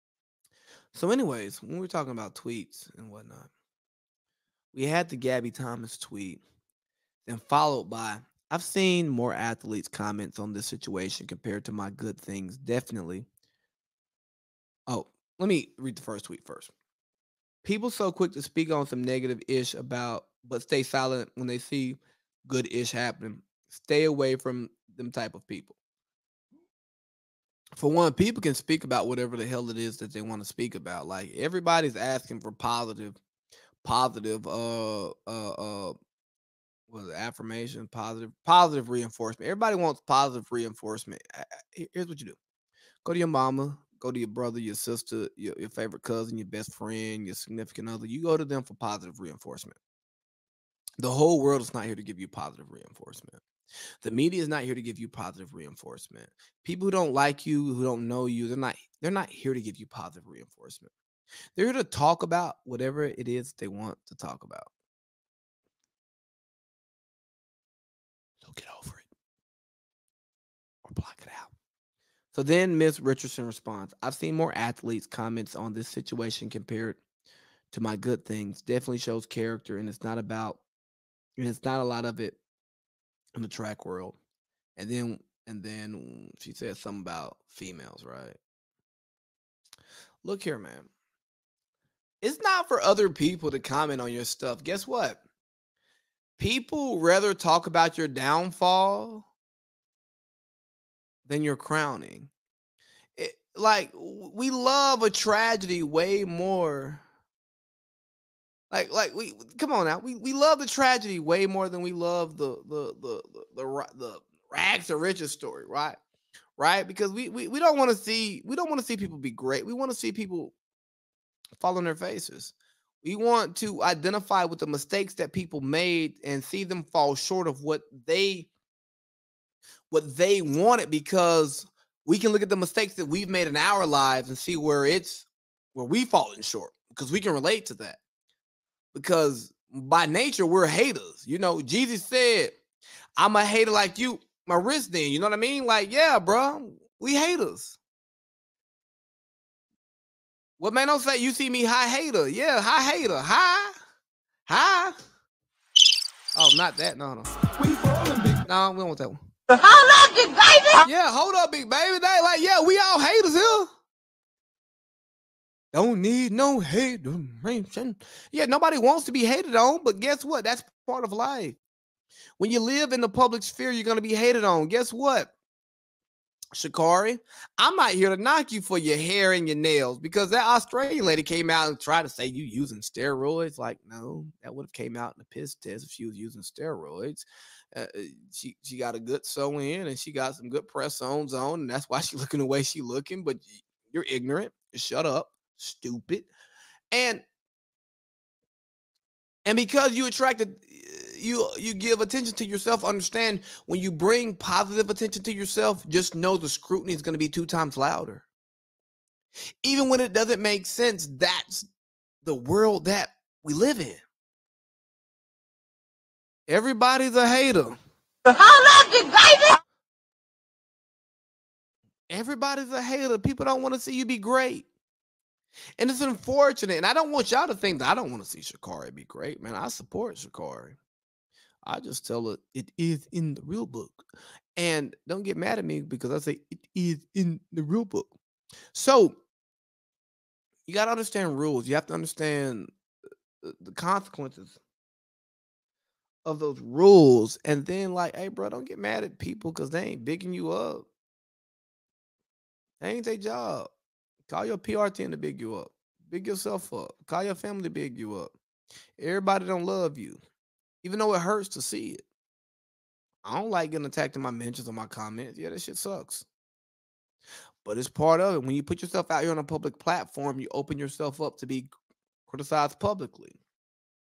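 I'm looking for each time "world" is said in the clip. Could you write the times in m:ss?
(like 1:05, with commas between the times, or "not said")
0:51, 1:23, 3:32.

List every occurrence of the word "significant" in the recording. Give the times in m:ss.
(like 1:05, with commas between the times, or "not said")
0:47.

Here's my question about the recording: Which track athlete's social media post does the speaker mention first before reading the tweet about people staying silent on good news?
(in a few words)
Gabby Thomas.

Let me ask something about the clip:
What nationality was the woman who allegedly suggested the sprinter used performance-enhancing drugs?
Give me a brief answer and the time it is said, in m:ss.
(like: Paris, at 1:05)
Australian, at 3:00.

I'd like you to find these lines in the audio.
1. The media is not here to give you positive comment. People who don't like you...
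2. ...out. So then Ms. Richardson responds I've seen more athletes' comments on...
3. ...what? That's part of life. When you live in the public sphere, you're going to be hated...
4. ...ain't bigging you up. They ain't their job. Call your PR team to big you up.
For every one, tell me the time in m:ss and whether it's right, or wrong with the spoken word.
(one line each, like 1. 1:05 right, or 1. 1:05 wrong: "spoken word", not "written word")
1. 0:54 wrong: "reinforcement", not "comment"
2. 1:11 right
3. 2:50 right
4. 4:09 right.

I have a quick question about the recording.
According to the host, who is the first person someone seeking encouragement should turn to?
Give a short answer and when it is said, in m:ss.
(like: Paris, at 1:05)
Your mama, at 0:43.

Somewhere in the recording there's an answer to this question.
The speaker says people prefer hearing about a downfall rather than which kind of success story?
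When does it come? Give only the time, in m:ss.
1:54.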